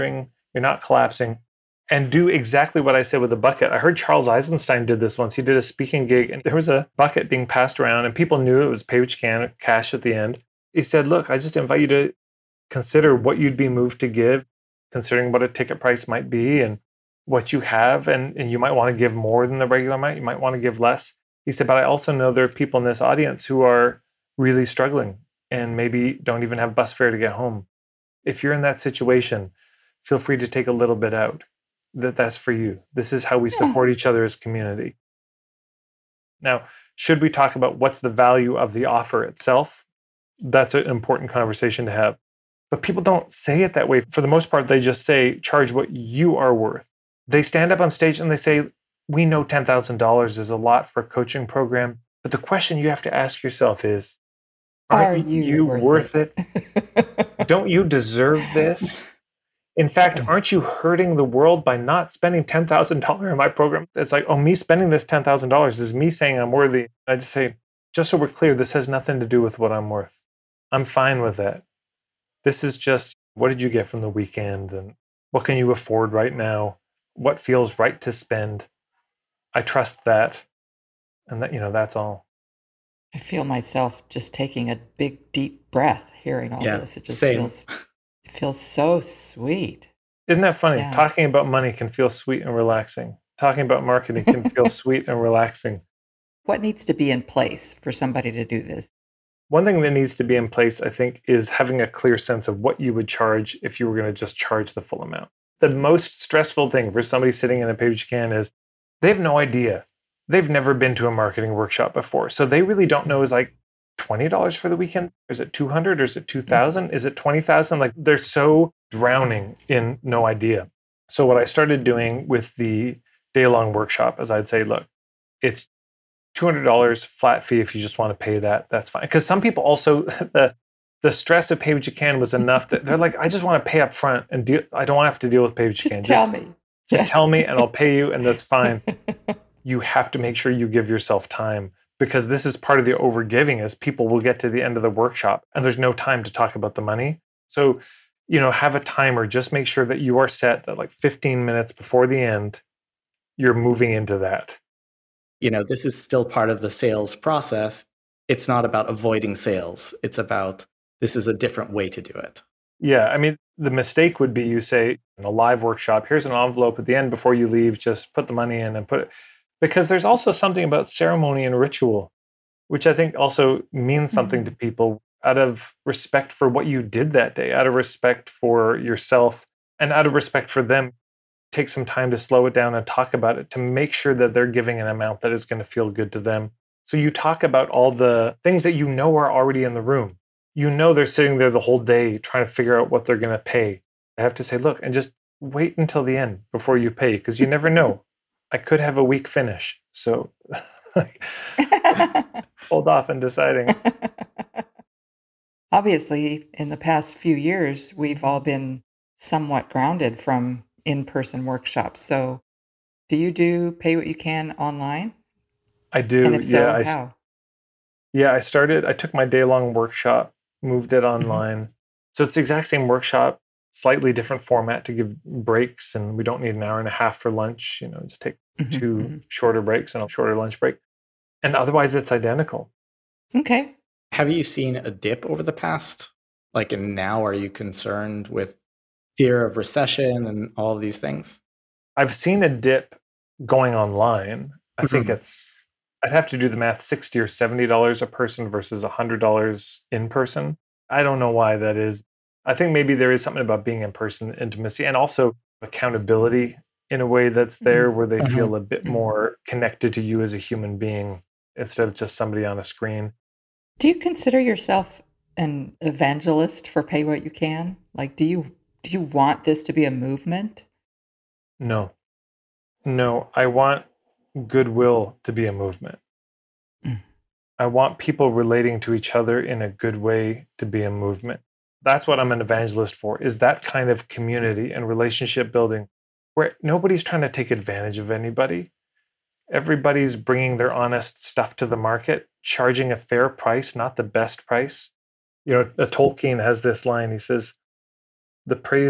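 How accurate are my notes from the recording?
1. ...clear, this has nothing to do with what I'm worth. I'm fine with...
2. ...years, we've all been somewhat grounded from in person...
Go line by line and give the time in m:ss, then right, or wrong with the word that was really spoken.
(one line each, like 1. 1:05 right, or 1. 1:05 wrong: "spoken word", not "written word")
1. 1:08 right
2. 3:27 right.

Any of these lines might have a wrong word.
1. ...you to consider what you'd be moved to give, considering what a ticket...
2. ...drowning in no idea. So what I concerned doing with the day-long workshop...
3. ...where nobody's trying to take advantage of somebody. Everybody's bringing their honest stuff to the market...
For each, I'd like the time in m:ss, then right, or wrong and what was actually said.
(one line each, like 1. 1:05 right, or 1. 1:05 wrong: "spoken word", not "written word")
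1. 0:11 right
2. 1:58 wrong: "started", not "concerned"
3. 4:46 wrong: "anybody", not "somebody".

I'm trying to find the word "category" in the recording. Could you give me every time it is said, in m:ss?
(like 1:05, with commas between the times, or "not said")
not said.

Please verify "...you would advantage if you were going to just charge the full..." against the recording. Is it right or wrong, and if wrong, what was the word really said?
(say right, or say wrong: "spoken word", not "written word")
wrong: "charge", not "advantage".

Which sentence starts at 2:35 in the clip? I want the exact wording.
You know, this is still part of the sales process.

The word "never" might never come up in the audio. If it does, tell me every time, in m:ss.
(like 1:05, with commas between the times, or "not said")
1:50, 3:17.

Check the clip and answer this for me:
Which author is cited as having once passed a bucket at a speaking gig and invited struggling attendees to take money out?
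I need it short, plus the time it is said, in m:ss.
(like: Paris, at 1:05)
Charles Eisenstein, at 0:03.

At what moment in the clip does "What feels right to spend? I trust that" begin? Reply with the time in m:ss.
1:17.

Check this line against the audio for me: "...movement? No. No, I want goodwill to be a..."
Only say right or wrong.
right.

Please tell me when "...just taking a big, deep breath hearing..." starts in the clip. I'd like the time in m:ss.
1:24.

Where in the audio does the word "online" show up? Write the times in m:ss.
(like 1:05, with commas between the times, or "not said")
3:34, 3:41, 4:03.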